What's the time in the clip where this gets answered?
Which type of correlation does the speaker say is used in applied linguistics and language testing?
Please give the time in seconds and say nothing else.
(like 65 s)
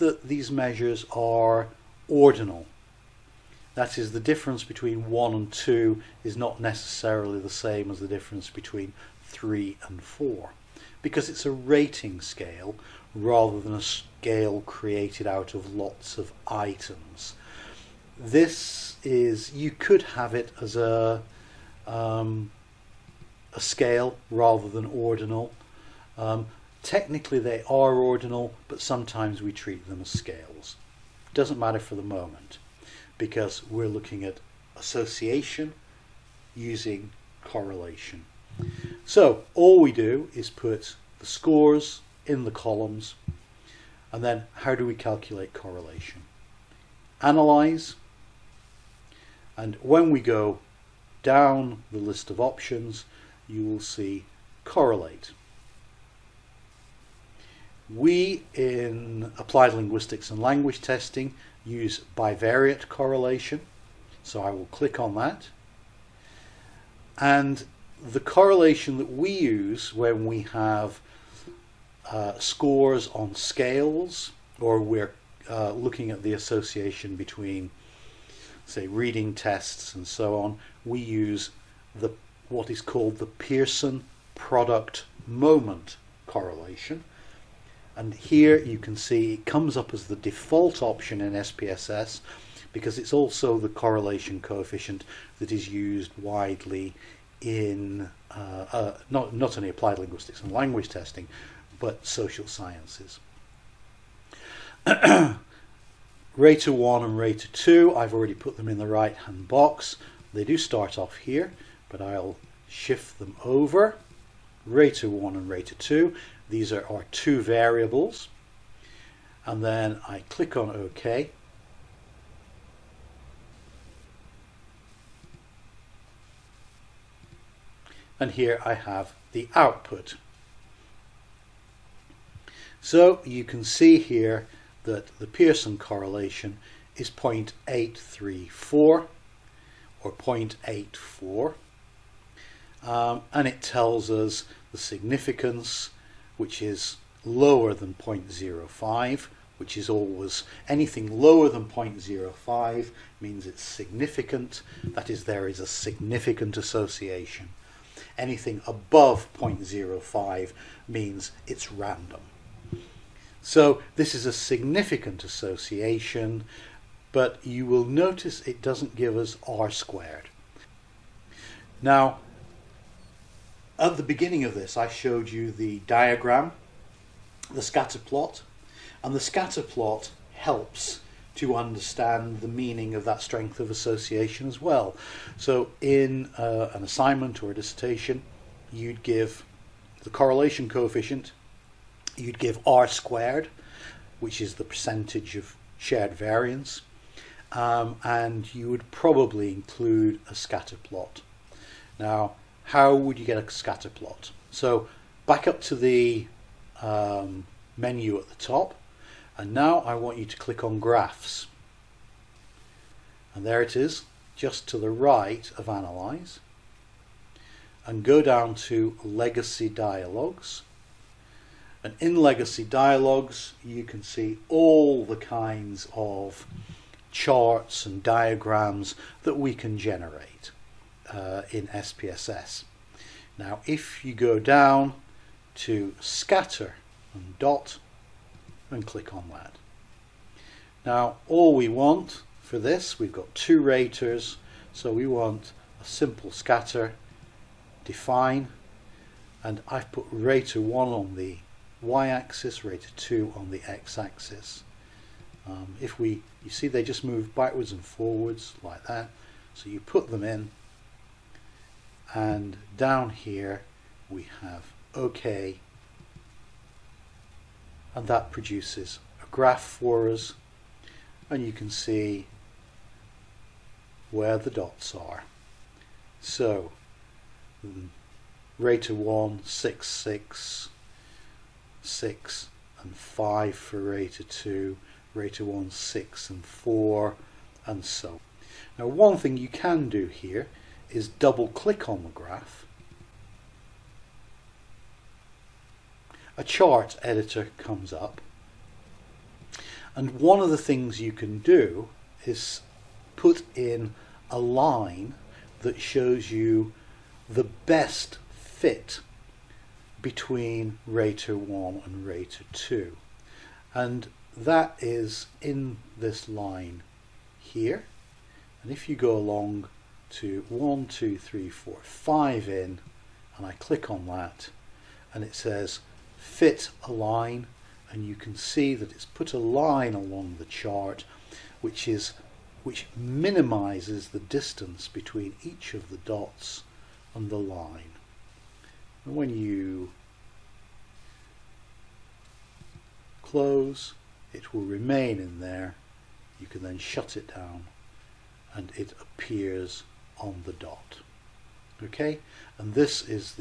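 62 s.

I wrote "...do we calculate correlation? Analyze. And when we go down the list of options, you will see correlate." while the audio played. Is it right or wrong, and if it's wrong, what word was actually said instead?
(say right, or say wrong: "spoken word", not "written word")
right.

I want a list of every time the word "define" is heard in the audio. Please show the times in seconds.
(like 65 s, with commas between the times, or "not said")
247 s.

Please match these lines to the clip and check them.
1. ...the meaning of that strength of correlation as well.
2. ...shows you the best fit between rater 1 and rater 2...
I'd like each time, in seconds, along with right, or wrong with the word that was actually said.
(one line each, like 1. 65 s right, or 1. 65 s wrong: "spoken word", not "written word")
1. 182 s wrong: "association", not "correlation"
2. 305 s right.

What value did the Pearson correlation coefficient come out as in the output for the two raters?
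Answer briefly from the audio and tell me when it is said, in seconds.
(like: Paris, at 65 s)
0.834, at 137 s.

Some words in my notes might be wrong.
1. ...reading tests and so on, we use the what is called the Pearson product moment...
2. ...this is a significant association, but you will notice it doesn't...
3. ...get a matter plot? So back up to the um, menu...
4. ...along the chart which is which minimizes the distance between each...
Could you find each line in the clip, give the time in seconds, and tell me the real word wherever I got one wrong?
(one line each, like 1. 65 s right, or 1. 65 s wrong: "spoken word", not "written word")
1. 78 s right
2. 163 s right
3. 203 s wrong: "scatter", not "matter"
4. 329 s right.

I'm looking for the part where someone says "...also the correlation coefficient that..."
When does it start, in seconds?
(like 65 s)
93 s.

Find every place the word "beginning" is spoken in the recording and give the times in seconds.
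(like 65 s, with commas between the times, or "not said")
174 s.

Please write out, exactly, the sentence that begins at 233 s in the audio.
Now, if you go down to scatter and dot and click on that.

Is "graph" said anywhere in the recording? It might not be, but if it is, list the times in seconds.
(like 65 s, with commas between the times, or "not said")
210 s, 269 s, 292 s.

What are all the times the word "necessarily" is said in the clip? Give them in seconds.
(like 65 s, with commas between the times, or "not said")
6 s.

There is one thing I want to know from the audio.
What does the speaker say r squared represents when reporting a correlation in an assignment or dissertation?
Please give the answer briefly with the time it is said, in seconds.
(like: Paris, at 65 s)
percentage of shared variance, at 194 s.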